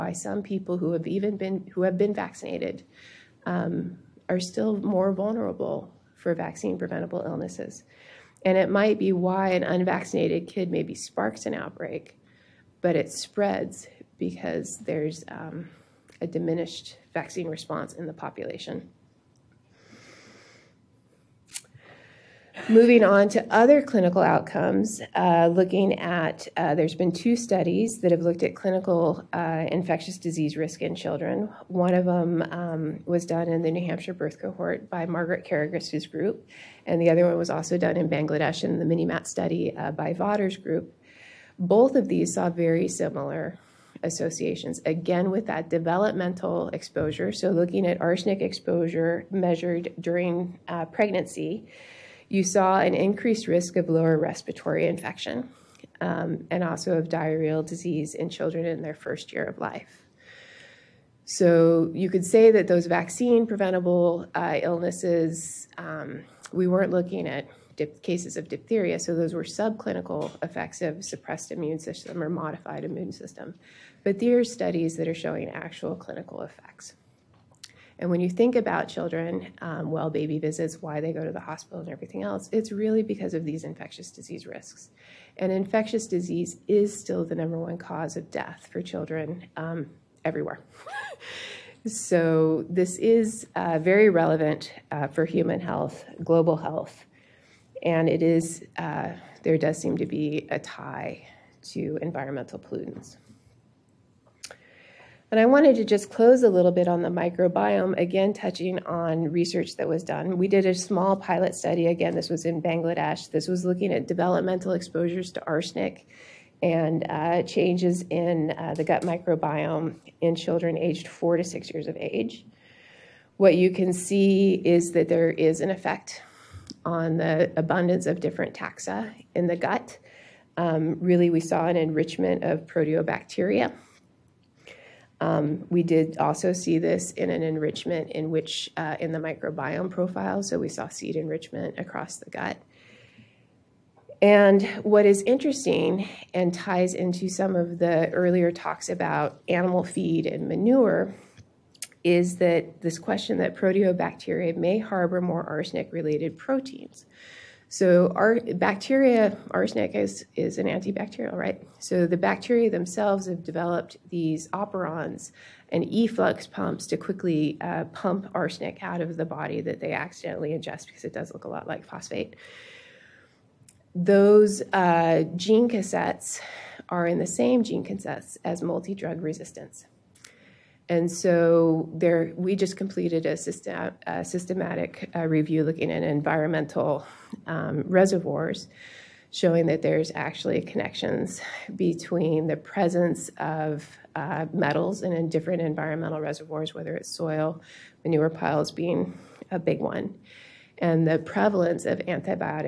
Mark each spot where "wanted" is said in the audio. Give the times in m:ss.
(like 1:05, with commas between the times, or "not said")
1:45.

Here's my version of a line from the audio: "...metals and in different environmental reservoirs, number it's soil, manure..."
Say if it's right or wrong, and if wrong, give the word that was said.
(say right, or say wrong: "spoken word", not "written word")
wrong: "whether", not "number".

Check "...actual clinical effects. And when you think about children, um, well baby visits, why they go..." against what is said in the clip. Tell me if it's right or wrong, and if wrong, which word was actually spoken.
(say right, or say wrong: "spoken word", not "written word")
right.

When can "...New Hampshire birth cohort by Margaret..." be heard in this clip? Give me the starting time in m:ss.
0:33.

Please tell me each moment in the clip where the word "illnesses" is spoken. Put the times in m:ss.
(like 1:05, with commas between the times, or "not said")
0:07, 1:04.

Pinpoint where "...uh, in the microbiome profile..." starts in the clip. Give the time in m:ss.
2:18.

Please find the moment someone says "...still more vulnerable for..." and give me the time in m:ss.
0:04.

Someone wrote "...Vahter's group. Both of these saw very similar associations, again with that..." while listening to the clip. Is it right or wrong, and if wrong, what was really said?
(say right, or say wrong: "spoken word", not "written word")
right.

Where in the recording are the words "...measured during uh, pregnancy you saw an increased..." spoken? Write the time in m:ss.
0:49.